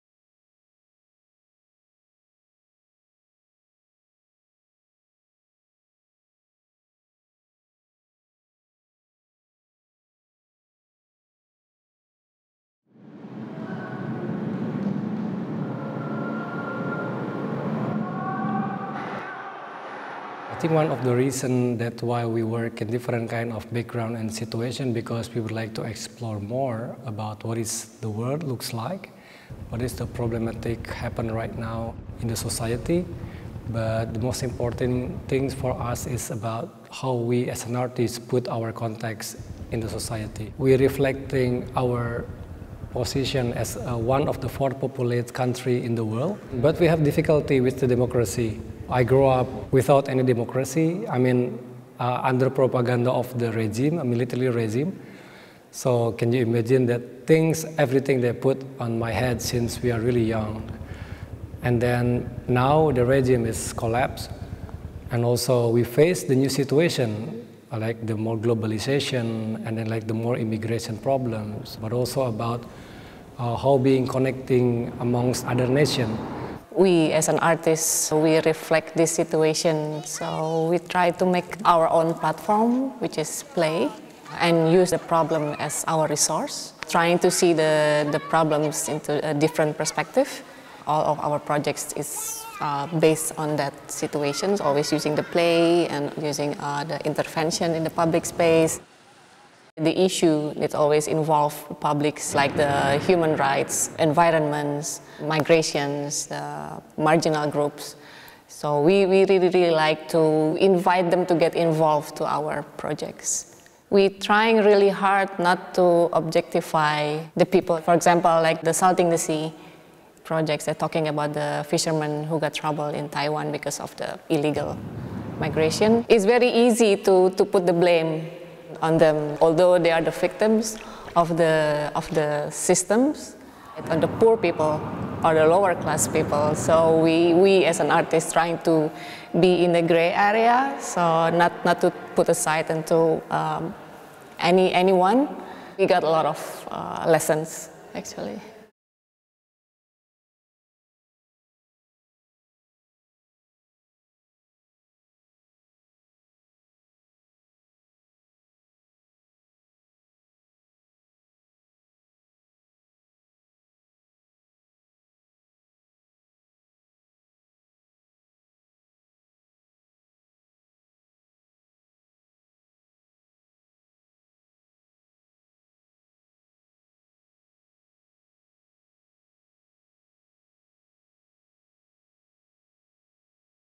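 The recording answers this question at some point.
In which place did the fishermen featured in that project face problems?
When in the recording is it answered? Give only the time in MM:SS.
02:03.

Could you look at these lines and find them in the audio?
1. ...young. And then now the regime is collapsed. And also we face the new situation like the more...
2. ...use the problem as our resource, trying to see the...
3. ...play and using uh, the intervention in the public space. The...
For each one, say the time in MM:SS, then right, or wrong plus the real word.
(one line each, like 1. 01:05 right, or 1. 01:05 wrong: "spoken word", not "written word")
1. 01:00 right
2. 01:24 right
3. 01:35 right.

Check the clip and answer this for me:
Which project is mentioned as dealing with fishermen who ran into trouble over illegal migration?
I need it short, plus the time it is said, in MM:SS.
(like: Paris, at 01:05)
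Salting the Sea, at 01:58.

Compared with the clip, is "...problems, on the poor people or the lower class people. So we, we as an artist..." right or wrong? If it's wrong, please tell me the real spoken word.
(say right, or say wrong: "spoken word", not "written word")
wrong: "systems", not "problems".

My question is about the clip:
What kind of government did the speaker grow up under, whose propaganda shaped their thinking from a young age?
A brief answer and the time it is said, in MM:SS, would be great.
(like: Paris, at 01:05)
Military regime, at 00:53.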